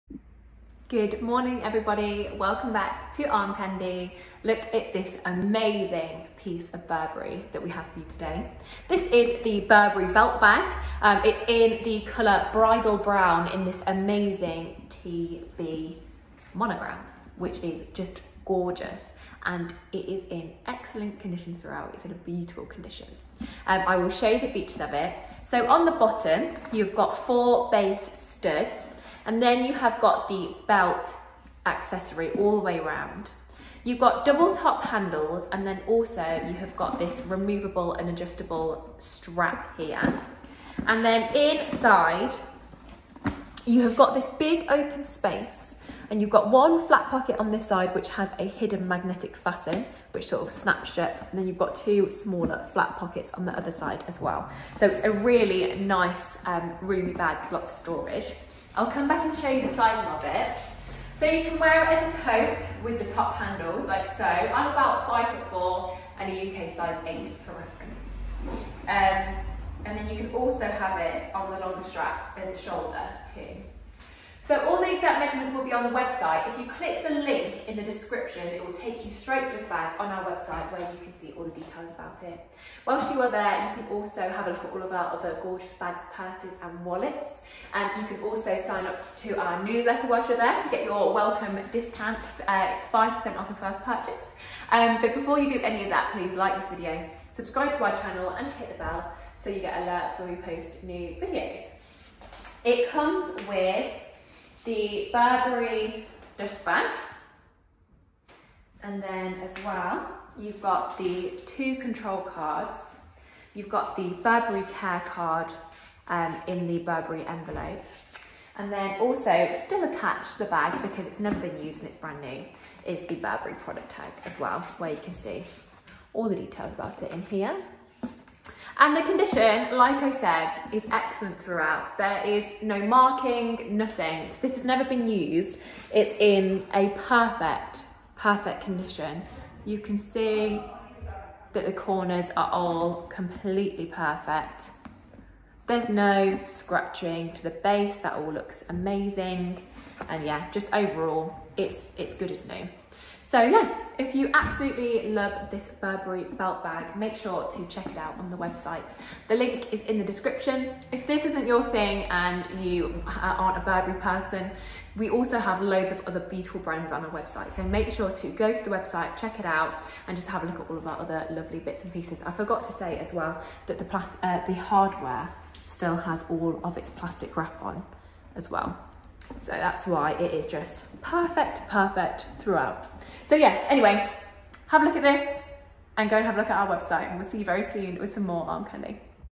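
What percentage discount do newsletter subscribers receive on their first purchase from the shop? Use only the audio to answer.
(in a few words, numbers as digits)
5%.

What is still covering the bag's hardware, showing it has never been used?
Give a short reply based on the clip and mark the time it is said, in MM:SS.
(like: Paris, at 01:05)
plastic wrap, at 02:56.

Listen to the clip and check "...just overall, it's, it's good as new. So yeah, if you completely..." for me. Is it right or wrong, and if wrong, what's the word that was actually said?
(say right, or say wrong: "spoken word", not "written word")
wrong: "absolutely", not "completely".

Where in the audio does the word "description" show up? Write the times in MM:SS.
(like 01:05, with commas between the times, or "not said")
01:17, 02:40.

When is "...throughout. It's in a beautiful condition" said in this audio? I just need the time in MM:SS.
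00:21.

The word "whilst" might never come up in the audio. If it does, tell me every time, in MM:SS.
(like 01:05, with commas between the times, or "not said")
01:22, 01:30.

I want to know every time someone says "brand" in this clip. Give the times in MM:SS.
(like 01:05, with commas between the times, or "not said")
02:01, 02:46.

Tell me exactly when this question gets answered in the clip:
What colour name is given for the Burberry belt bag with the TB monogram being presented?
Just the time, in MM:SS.
00:12.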